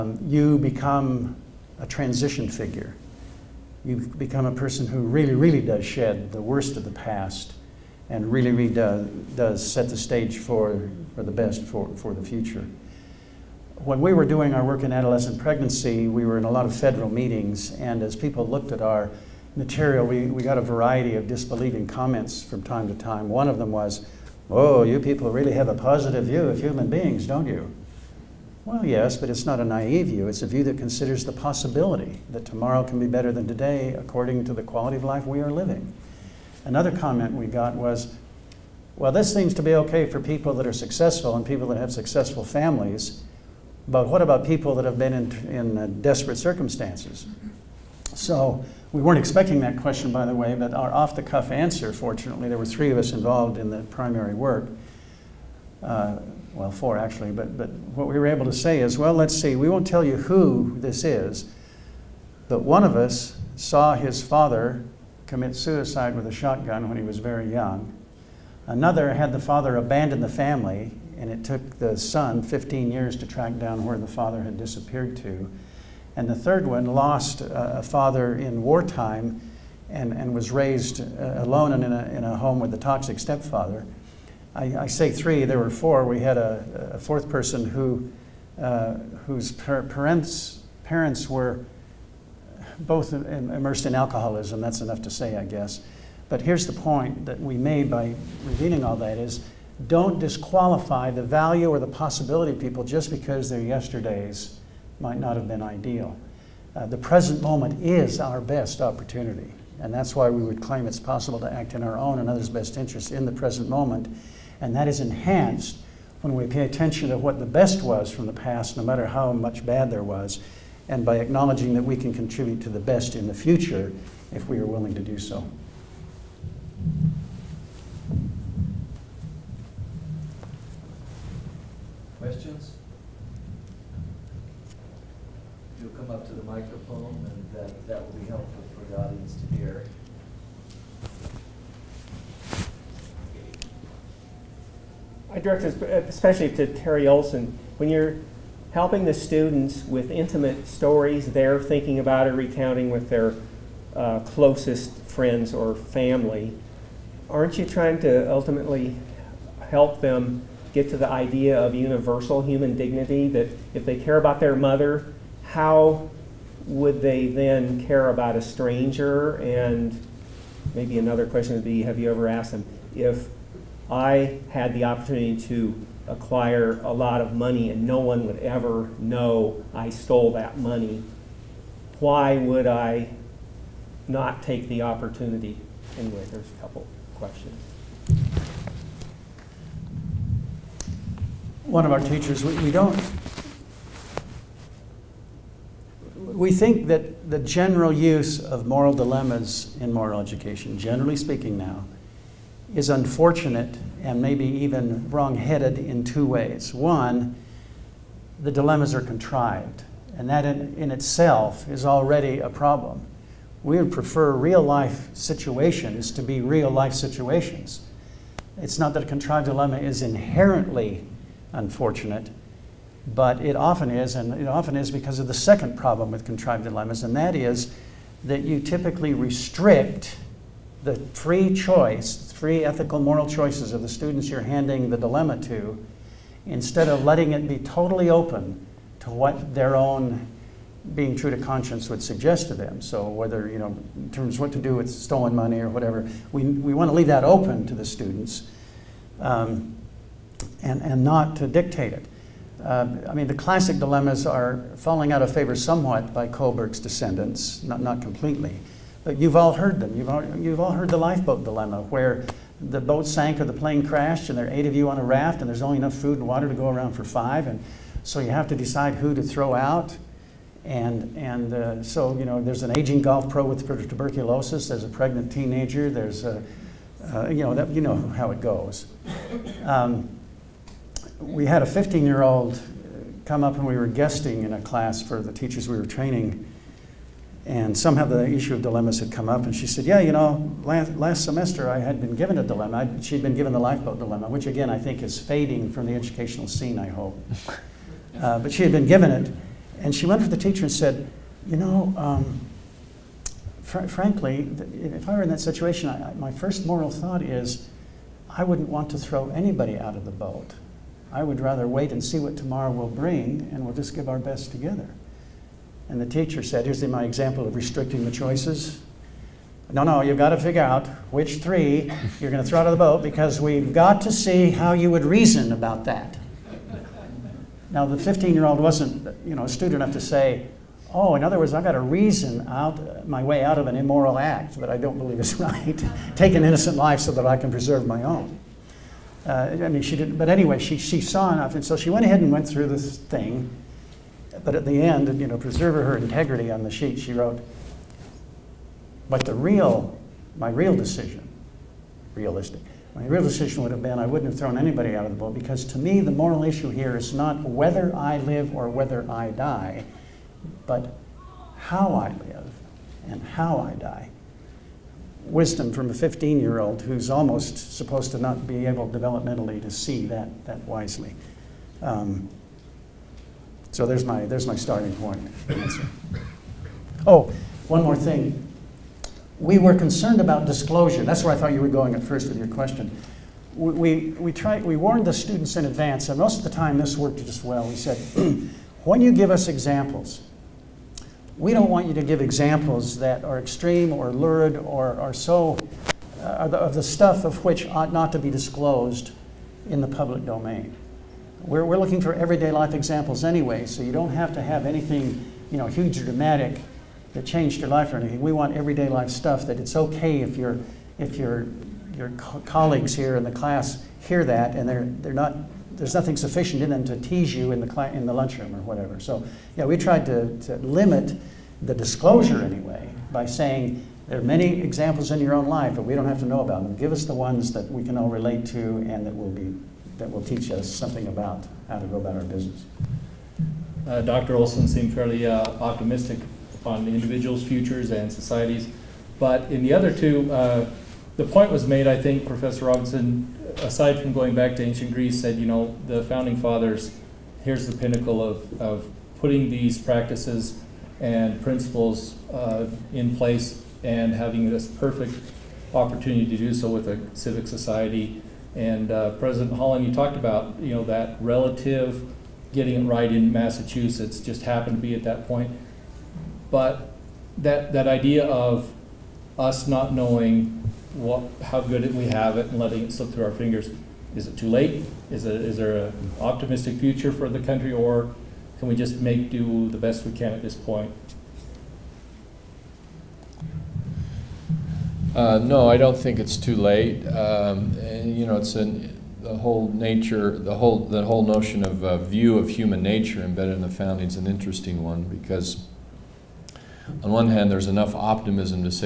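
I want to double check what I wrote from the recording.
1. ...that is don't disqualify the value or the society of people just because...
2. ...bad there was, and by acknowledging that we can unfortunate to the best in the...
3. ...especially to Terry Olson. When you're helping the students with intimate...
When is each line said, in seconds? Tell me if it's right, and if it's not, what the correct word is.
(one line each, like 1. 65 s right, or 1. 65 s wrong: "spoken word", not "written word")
1. 98 s wrong: "possibility", not "society"
2. 119 s wrong: "contribute", not "unfortunate"
3. 146 s right.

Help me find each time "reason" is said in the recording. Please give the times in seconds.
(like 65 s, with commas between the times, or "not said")
325 s, 331 s.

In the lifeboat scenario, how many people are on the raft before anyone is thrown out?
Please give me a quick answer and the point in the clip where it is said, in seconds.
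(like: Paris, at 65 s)
8, at 264 s.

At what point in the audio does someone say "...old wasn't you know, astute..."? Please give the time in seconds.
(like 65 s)
328 s.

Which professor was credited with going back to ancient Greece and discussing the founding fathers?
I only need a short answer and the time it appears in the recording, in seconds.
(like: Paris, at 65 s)
Professor Robinson, at 442 s.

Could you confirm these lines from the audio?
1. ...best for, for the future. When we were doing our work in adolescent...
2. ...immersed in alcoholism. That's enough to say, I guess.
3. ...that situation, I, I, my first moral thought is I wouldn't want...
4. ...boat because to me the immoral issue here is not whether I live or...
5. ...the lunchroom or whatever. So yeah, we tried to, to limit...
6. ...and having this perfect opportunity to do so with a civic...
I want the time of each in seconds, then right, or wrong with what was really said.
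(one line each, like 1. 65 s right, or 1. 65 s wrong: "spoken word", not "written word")
1. 11 s right
2. 93 s right
3. 305 s right
4. 355 s wrong: "moral", not "immoral"
5. 418 s right
6. 453 s right.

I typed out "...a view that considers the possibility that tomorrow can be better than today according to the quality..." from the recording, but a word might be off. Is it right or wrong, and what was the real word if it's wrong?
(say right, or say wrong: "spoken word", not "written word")
right.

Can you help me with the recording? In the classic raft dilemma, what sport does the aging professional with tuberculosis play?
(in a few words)
golf.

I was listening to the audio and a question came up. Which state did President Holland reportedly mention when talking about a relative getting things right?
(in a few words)
Massachusetts.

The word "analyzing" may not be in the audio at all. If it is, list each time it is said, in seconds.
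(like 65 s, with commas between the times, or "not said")
not said.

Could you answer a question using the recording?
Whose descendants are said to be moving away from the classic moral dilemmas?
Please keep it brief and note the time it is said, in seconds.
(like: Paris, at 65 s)
Kohlberg, at 256 s.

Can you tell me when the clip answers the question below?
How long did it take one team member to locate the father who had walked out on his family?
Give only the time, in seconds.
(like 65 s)
72 s.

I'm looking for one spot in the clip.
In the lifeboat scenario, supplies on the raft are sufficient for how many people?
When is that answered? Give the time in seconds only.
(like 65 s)
267 s.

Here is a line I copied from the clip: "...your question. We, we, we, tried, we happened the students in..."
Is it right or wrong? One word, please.
wrong.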